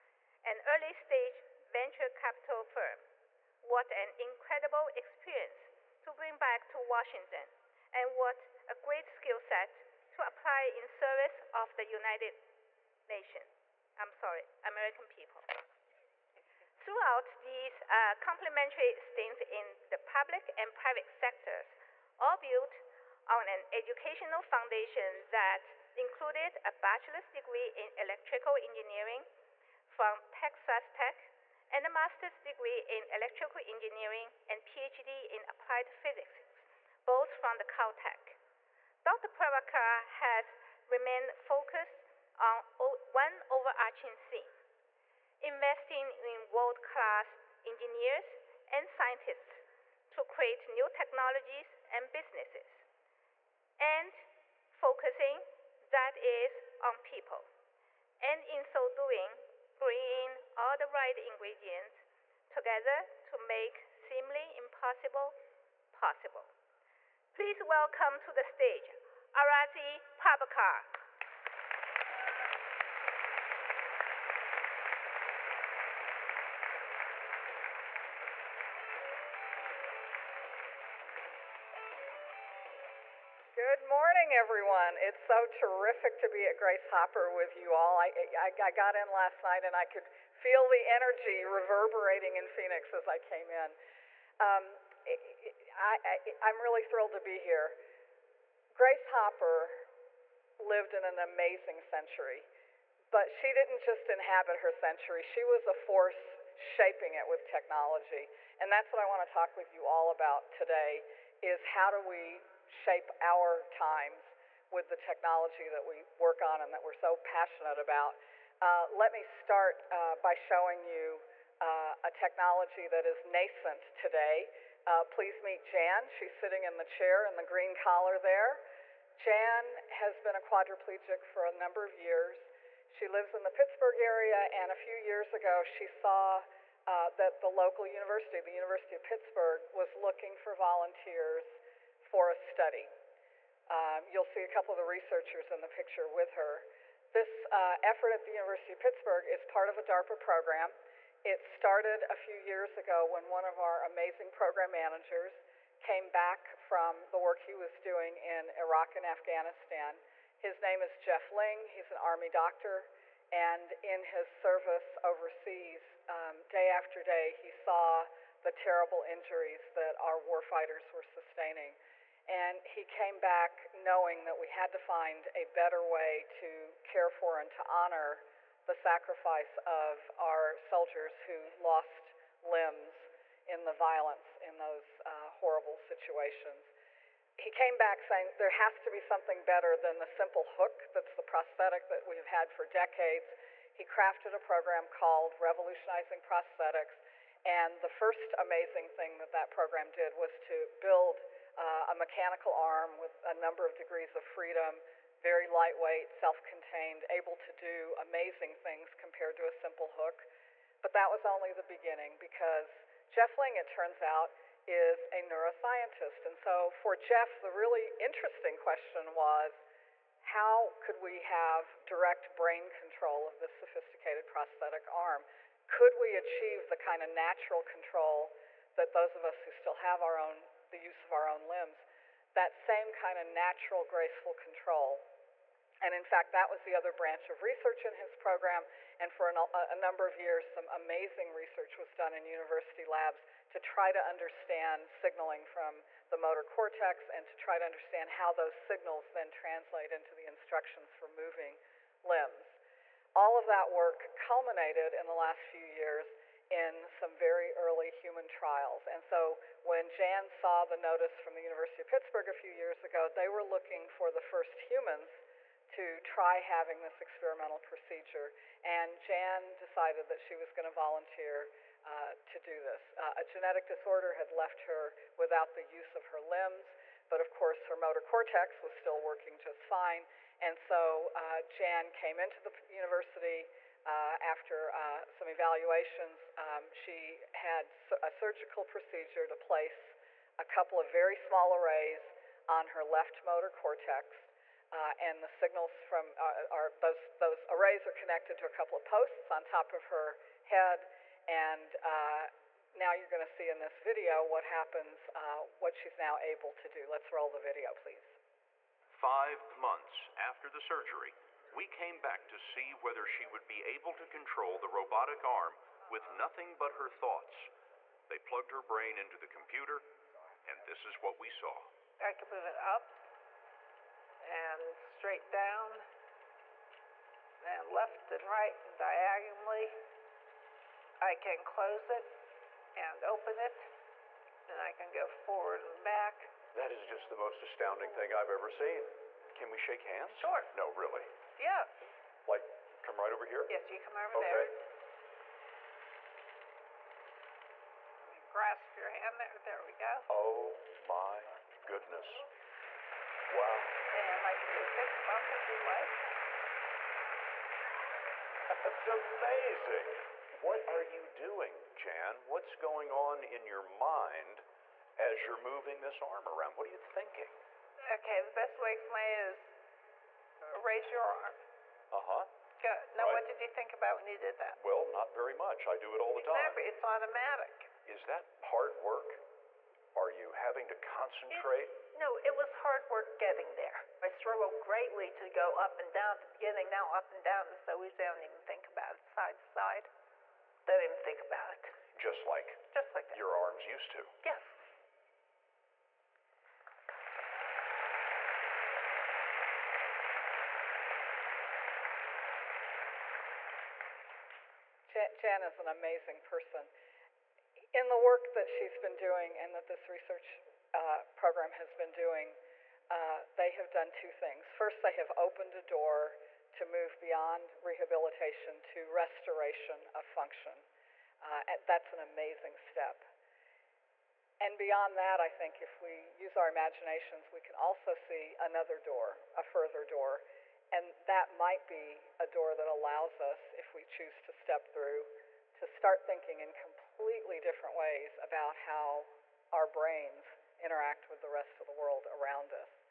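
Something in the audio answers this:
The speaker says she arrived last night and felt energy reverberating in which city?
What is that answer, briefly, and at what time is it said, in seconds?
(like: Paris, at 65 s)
Phoenix, at 92 s.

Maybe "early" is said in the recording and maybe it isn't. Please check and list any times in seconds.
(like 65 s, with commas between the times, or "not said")
0 s, 257 s.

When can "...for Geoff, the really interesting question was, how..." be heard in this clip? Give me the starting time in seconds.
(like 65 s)
216 s.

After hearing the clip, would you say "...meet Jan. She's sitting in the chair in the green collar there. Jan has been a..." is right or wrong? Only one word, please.
right.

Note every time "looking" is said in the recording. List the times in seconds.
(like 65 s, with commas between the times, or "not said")
139 s, 263 s.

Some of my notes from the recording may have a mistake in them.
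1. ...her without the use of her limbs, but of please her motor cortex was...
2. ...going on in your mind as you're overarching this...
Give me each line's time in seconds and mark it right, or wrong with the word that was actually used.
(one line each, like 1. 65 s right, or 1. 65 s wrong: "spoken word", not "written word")
1. 274 s wrong: "course", not "please"
2. 362 s wrong: "moving", not "overarching".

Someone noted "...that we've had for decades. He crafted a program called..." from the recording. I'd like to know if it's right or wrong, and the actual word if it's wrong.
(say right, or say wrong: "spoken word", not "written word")
right.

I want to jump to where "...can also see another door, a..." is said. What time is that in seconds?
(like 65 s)
427 s.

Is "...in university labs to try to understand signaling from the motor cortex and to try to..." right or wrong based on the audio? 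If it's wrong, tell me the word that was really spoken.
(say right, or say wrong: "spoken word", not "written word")
right.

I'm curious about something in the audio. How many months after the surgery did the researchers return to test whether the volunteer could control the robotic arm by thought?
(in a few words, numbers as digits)
5.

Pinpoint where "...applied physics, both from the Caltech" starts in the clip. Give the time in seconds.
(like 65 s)
35 s.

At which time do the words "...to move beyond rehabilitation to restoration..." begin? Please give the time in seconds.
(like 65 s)
416 s.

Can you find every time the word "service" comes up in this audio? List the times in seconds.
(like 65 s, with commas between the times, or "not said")
10 s, 164 s.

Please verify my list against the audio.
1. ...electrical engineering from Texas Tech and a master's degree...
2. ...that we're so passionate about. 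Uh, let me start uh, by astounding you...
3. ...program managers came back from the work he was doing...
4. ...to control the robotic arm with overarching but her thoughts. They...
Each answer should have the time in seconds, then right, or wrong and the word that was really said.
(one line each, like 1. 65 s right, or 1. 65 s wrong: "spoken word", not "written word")
1. 27 s right
2. 116 s wrong: "showing", not "astounding"
3. 154 s right
4. 313 s wrong: "nothing", not "overarching".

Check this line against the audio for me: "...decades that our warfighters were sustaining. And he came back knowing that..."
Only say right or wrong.
wrong.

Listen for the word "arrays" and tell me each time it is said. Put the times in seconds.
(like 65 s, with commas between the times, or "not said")
291 s, 297 s.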